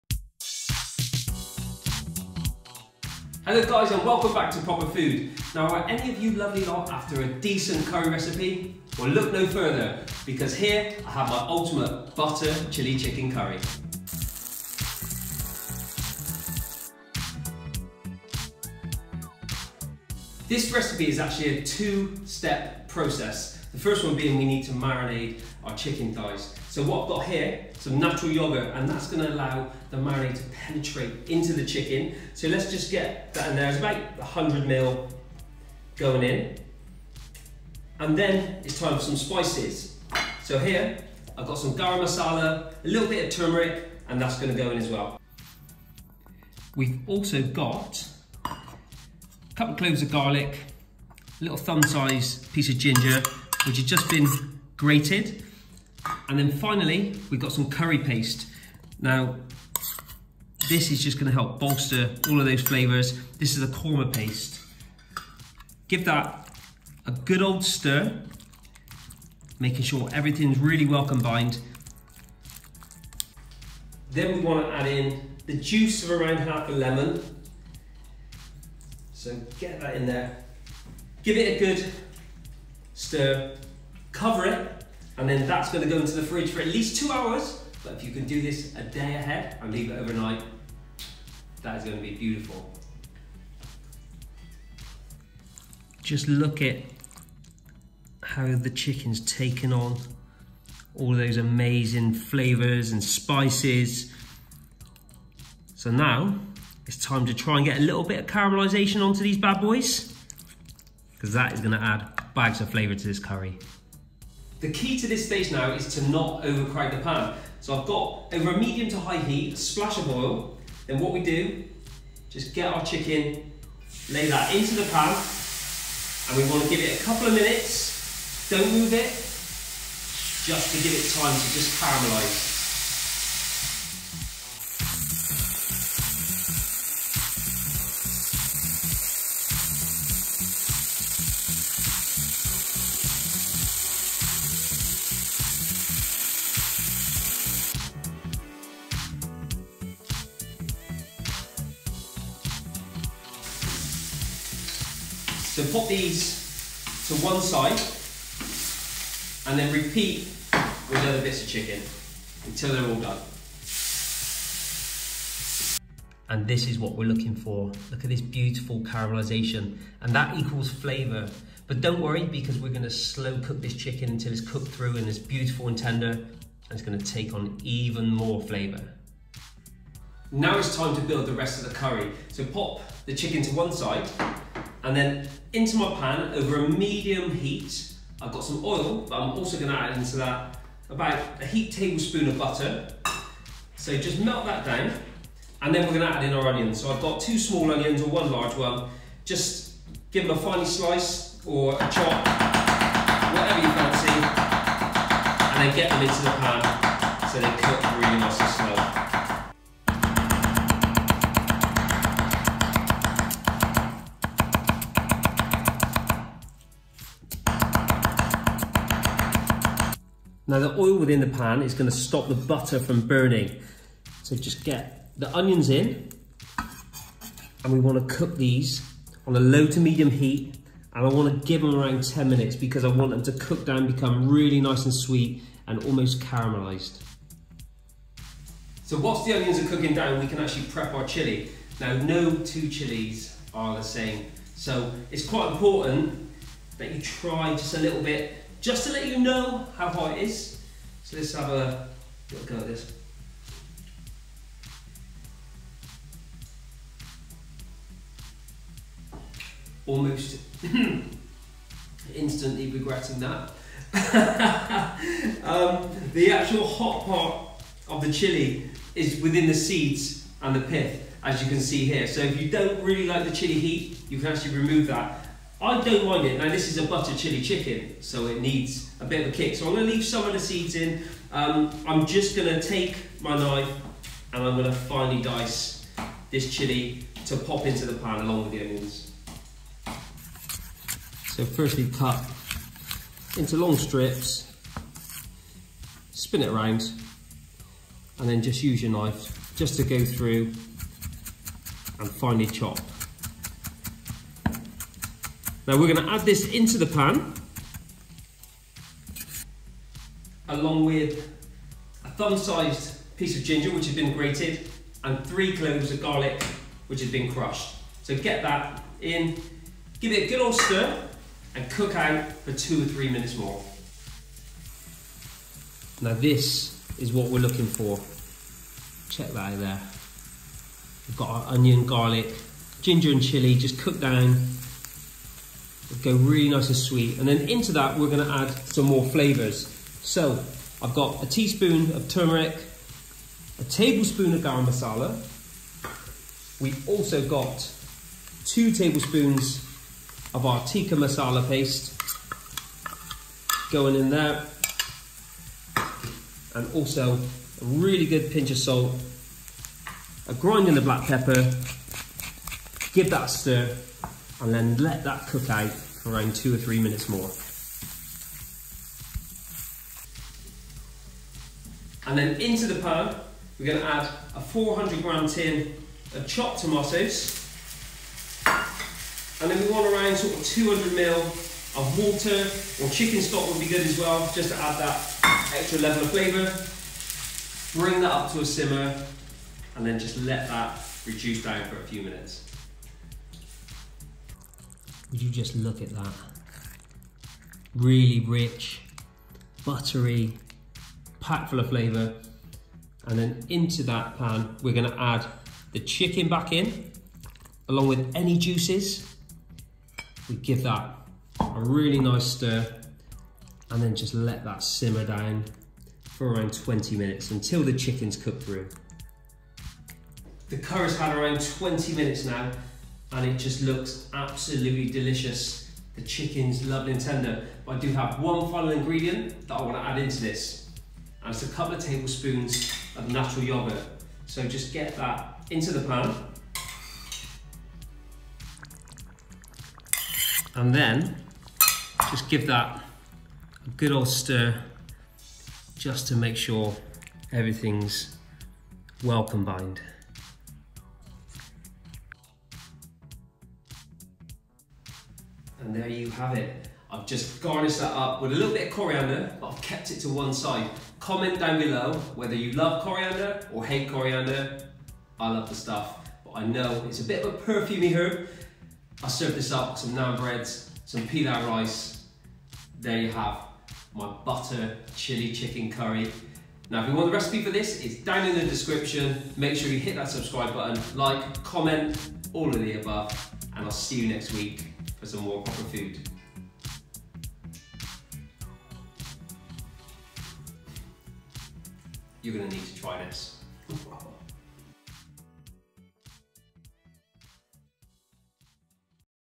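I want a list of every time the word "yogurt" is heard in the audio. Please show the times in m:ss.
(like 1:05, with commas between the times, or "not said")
0:28, 7:13.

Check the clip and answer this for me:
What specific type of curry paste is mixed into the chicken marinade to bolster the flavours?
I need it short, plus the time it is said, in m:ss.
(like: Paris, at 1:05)
Korma paste, at 1:03.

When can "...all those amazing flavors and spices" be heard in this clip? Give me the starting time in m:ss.
1:40.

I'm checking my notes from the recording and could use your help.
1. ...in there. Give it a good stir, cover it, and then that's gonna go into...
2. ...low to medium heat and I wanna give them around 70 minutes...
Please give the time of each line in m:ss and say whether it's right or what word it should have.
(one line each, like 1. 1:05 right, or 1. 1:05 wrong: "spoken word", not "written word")
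1. 1:19 right
2. 3:49 wrong: "10", not "70".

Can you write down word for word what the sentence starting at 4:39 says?
So I'm gonna leave some of the seeds in.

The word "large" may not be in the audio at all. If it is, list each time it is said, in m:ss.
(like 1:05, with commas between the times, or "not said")
3:18.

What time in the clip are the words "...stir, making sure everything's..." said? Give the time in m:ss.
1:07.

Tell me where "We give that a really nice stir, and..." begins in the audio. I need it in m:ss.
6:50.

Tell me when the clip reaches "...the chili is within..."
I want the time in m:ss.
4:28.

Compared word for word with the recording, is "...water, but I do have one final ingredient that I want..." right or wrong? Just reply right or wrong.
wrong.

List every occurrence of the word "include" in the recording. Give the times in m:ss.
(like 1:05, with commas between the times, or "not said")
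not said.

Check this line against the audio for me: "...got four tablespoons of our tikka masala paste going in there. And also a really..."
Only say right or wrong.
wrong.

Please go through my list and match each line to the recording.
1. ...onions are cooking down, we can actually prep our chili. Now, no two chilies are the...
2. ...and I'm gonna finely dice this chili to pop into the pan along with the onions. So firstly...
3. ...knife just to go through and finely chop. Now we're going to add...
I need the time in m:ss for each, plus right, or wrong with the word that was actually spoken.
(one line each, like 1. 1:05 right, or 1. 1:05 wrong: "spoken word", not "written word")
1. 3:59 right
2. 4:44 right
3. 4:58 right.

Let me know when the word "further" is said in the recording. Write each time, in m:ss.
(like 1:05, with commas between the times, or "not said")
0:09.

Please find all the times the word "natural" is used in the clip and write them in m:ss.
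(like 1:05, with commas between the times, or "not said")
0:27, 7:13.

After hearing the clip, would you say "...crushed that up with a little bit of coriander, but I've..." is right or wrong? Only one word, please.
wrong.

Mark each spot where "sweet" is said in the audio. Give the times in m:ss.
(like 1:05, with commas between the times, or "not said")
3:54, 5:36.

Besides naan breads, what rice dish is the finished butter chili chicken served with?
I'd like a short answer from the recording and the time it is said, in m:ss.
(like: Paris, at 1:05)
Pilau rice, at 7:51.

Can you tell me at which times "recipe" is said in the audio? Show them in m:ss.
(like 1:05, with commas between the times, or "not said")
0:08, 0:20, 7:57.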